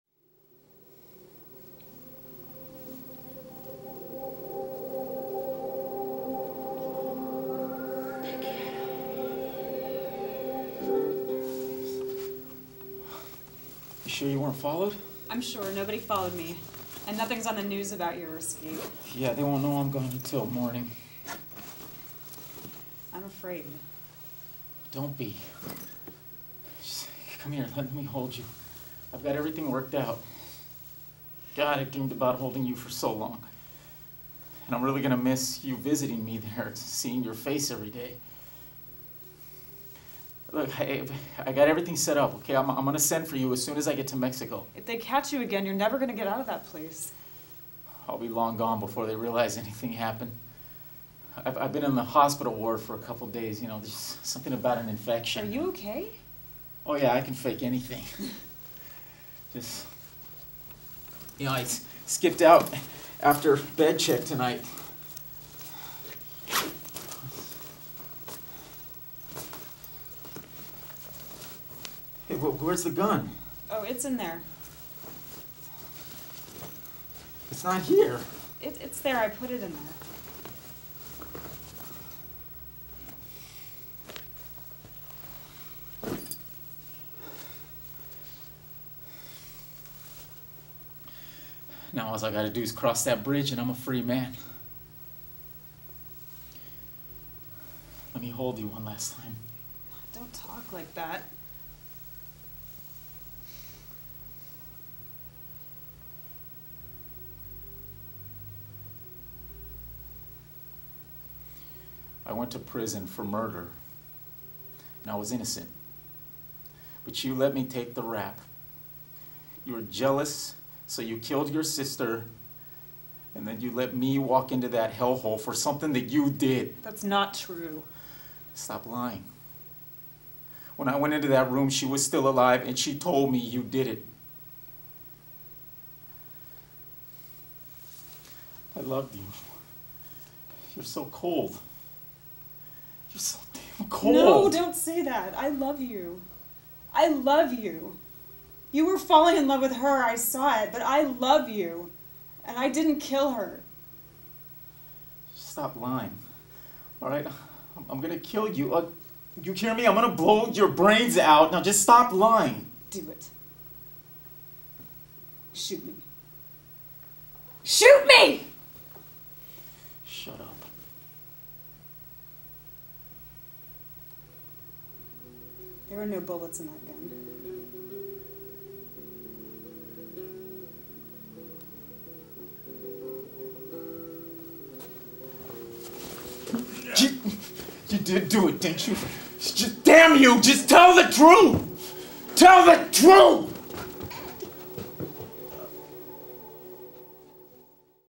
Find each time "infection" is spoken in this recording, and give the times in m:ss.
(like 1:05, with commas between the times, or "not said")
0:54.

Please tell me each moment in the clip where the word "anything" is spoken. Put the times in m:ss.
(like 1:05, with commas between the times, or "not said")
0:49, 0:57.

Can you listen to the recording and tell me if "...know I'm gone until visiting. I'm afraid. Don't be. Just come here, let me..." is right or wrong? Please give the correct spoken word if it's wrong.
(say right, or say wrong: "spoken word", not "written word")
wrong: "morning", not "visiting".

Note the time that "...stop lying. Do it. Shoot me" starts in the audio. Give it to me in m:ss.
2:41.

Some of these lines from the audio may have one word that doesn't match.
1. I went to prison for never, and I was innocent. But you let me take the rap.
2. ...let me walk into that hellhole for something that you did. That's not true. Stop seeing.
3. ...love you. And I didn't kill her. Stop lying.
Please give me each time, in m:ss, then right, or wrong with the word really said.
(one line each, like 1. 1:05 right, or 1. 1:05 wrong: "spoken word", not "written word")
1. 1:52 wrong: "murder", not "never"
2. 2:03 wrong: "lying", not "seeing"
3. 2:31 right.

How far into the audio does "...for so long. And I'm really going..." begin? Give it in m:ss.
0:32.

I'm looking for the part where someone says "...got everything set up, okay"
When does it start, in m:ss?
0:41.